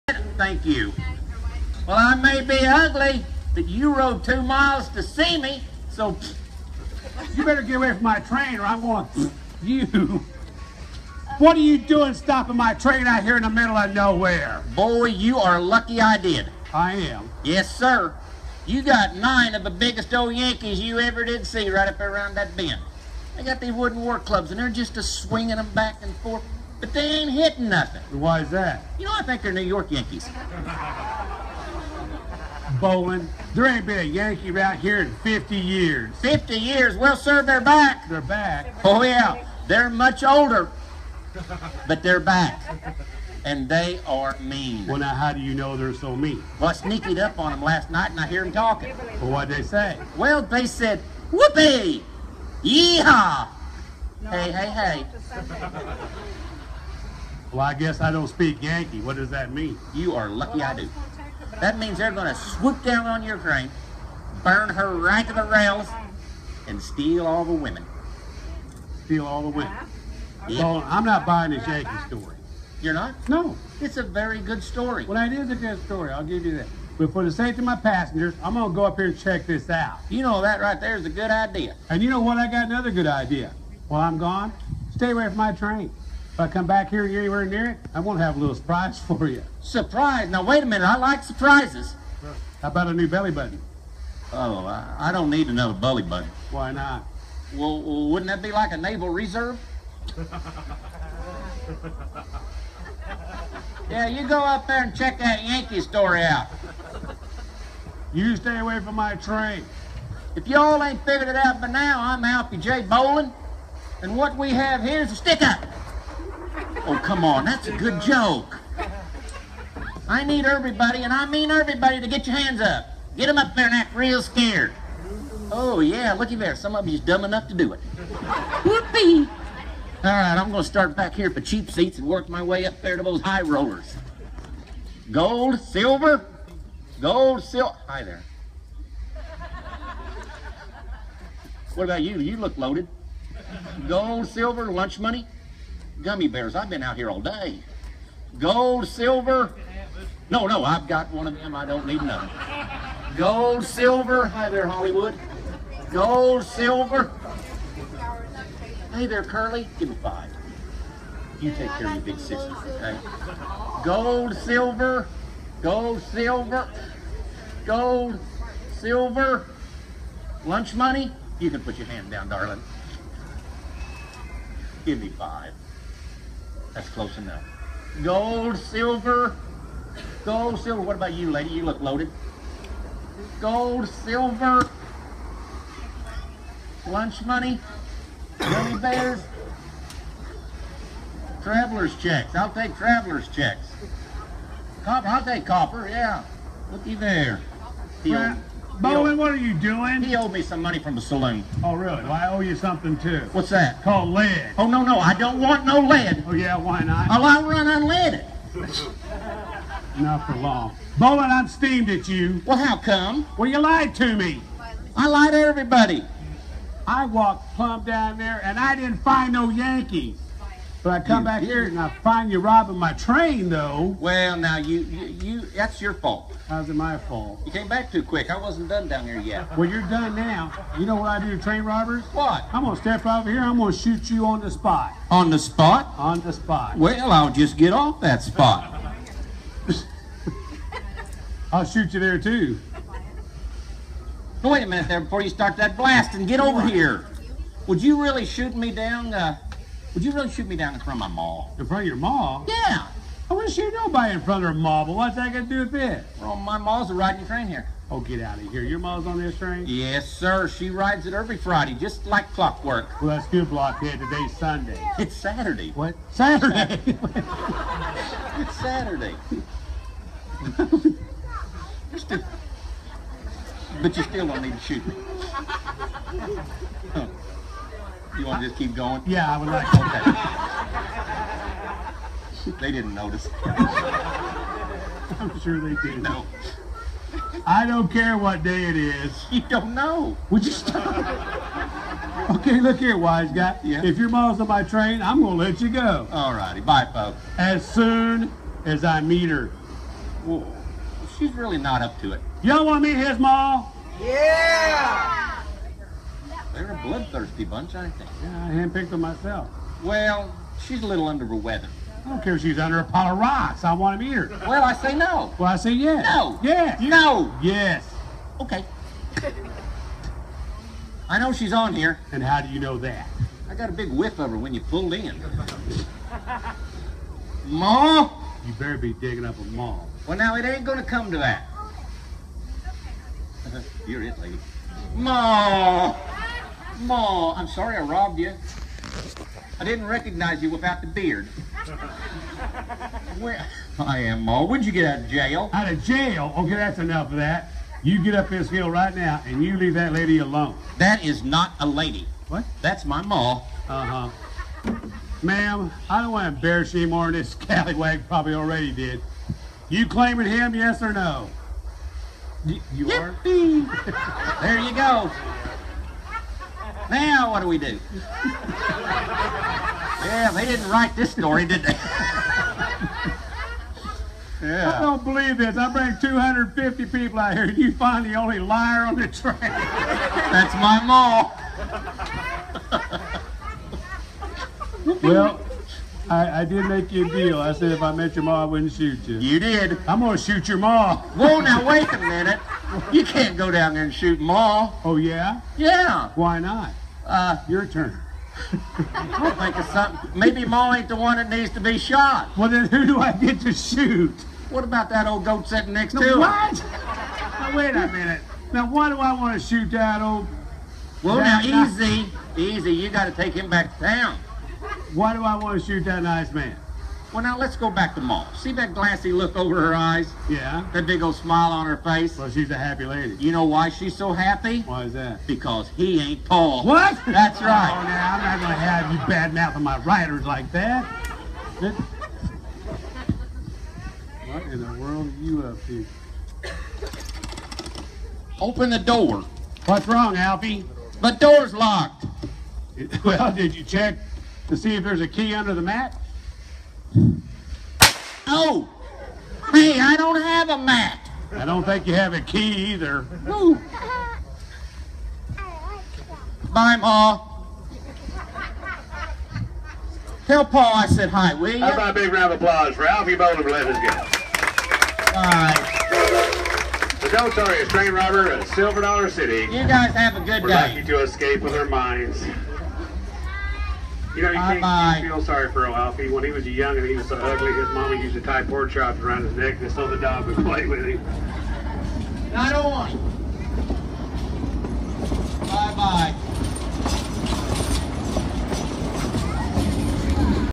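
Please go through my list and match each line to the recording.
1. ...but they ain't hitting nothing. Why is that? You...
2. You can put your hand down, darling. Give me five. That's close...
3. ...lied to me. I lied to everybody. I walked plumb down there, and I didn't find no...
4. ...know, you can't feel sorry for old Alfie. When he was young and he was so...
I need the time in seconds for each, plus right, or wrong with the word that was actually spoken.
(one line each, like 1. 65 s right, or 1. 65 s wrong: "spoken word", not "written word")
1. 26 s right
2. 171 s right
3. 213 s right
4. 474 s right.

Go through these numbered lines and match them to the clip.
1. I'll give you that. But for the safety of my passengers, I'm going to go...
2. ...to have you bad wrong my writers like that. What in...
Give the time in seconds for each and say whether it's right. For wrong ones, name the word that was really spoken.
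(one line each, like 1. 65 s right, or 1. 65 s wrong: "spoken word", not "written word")
1. 76 s right
2. 428 s wrong: "mouthing", not "wrong".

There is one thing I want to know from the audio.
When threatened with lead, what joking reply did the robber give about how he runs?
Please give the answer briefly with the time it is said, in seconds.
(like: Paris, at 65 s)
Unleaded, at 207 s.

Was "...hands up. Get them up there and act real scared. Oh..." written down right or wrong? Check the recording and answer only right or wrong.
right.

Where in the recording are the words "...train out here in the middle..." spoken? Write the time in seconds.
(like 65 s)
12 s.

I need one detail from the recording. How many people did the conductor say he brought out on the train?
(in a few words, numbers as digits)
250.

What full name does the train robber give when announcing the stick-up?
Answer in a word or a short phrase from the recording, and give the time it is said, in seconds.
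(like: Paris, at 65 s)
Alfie J. Bowling, at 112 s.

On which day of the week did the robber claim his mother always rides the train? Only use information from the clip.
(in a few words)
Friday.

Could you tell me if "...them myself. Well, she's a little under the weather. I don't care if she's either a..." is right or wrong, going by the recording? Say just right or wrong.
wrong.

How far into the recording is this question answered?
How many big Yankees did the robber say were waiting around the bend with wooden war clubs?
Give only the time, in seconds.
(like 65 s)
19 s.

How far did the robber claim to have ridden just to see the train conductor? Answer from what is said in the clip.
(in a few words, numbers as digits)
2 miles.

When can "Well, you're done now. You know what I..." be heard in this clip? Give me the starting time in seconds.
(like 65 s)
229 s.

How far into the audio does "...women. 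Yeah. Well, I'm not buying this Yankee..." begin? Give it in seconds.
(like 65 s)
69 s.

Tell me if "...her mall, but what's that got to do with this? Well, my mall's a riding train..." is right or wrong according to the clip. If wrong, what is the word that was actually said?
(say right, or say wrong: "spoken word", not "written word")
right.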